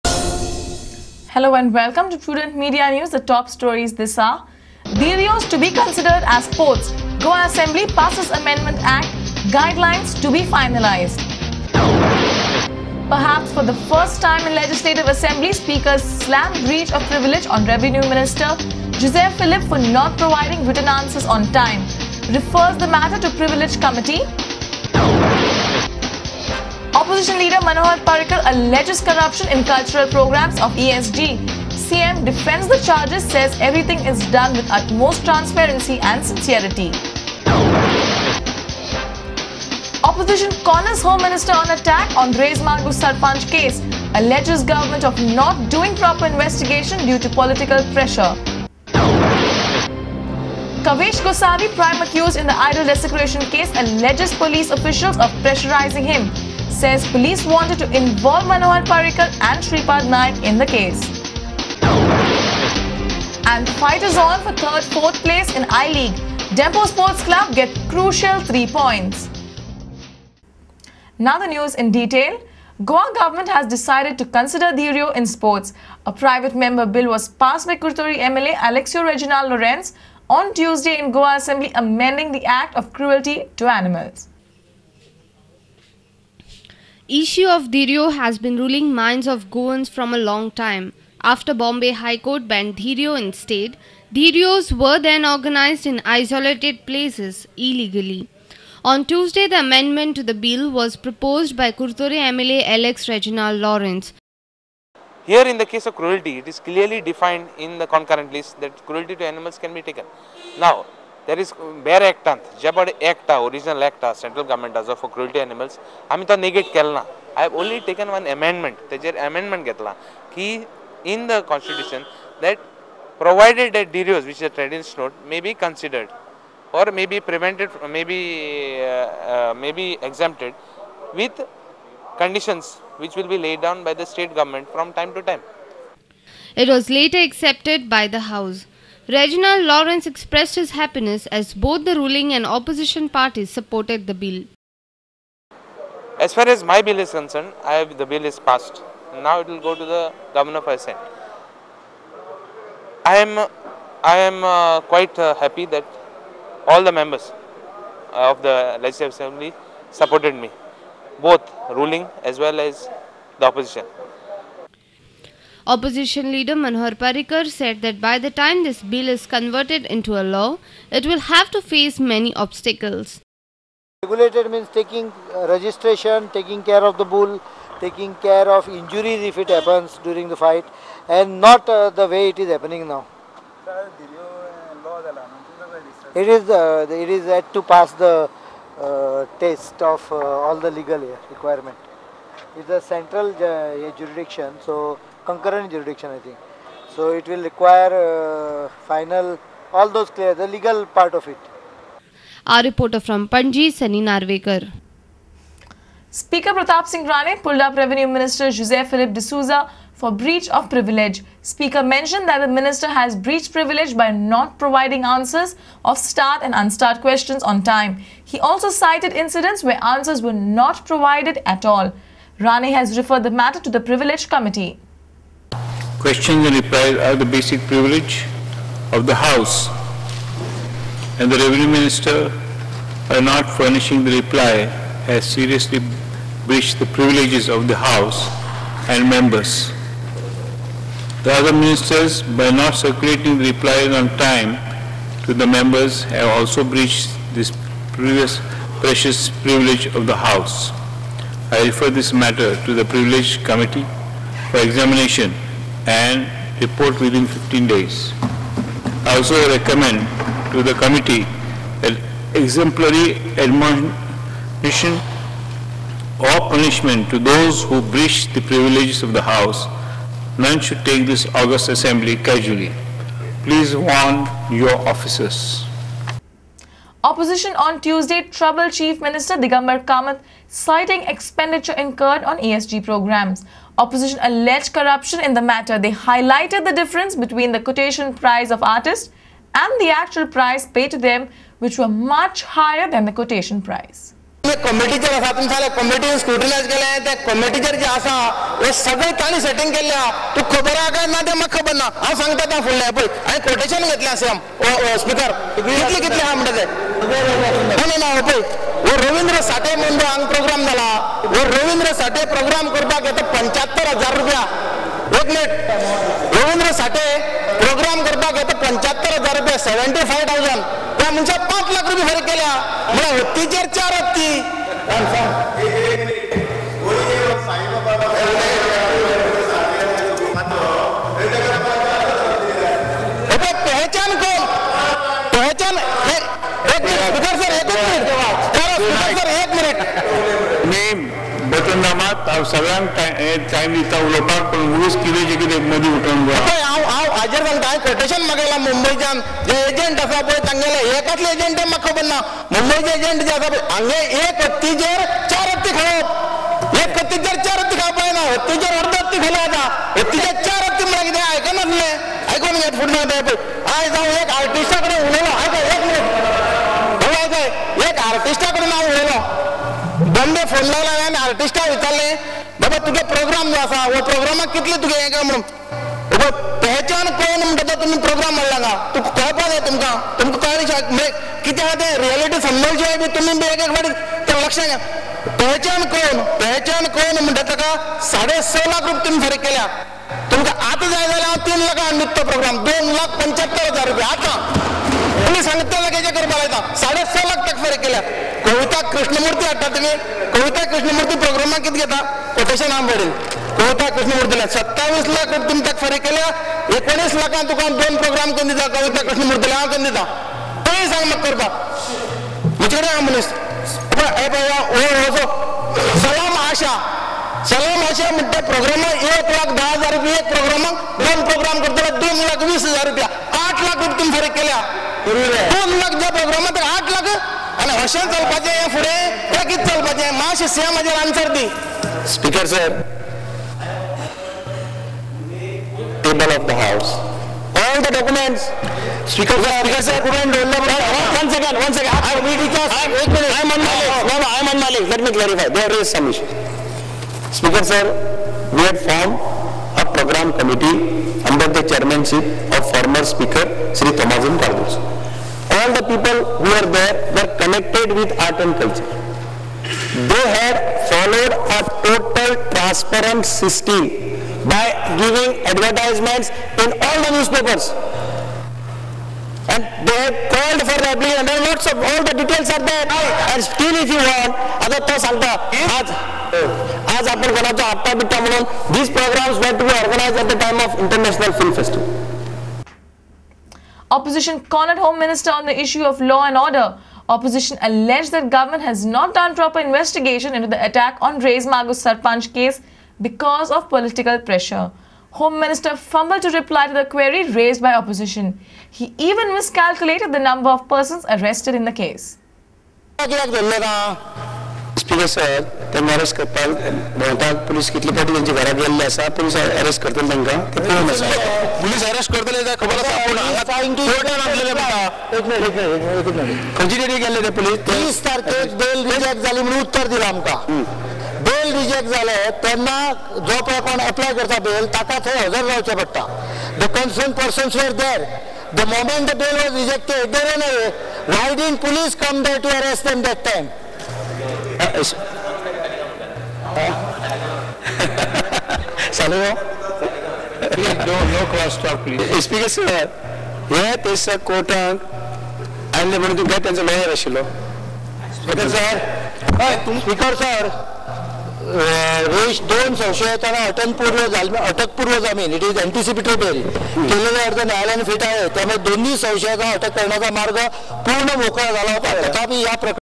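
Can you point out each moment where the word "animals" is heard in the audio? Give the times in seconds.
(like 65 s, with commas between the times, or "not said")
83 s, 109 s, 115 s.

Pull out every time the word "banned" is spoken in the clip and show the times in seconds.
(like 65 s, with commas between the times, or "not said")
92 s.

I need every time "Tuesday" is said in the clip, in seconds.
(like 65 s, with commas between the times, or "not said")
80 s, 99 s, 277 s.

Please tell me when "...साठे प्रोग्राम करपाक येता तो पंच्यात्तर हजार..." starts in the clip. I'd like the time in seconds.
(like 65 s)
312 s.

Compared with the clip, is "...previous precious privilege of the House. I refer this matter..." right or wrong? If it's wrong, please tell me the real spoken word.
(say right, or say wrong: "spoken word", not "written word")
right.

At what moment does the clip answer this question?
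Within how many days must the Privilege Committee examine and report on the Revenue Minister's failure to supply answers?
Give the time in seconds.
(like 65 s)
257 s.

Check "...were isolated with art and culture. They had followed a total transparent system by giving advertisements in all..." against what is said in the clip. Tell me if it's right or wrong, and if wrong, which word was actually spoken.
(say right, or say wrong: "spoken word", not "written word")
wrong: "connected", not "isolated".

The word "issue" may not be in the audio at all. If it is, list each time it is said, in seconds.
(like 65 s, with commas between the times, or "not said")
87 s, 485 s.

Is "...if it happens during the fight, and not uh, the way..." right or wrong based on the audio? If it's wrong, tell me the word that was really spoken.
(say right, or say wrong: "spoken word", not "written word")
right.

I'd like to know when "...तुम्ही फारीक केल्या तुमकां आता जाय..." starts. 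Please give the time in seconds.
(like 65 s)
389 s.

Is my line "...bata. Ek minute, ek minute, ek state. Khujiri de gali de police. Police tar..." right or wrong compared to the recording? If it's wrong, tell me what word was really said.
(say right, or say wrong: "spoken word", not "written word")
wrong: "minute", not "state".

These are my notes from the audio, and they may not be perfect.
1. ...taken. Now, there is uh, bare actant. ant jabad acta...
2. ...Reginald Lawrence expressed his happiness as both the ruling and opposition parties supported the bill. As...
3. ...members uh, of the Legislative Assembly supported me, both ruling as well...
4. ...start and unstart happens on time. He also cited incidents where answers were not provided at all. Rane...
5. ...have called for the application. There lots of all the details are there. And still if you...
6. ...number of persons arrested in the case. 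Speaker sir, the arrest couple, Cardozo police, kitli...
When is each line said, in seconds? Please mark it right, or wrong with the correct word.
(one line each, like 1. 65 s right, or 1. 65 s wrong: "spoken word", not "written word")
1. 109 s right
2. 139 s right
3. 156 s right
4. 215 s wrong: "questions", not "happens"
5. 470 s right
6. 500 s wrong: "Bogota", not "Cardozo".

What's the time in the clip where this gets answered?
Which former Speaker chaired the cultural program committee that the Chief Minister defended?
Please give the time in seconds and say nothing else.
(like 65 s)
453 s.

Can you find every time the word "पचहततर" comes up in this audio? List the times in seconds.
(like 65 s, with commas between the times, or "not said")
318 s.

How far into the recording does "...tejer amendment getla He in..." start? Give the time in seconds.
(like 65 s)
118 s.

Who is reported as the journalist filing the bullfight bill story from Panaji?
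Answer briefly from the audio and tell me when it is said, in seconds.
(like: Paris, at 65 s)
Sunny Narvekar, at 203 s.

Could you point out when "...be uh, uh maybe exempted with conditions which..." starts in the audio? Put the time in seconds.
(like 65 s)
128 s.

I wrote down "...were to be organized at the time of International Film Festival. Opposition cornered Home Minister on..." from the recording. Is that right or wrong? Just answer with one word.
right.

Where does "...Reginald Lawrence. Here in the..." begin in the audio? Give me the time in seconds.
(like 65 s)
103 s.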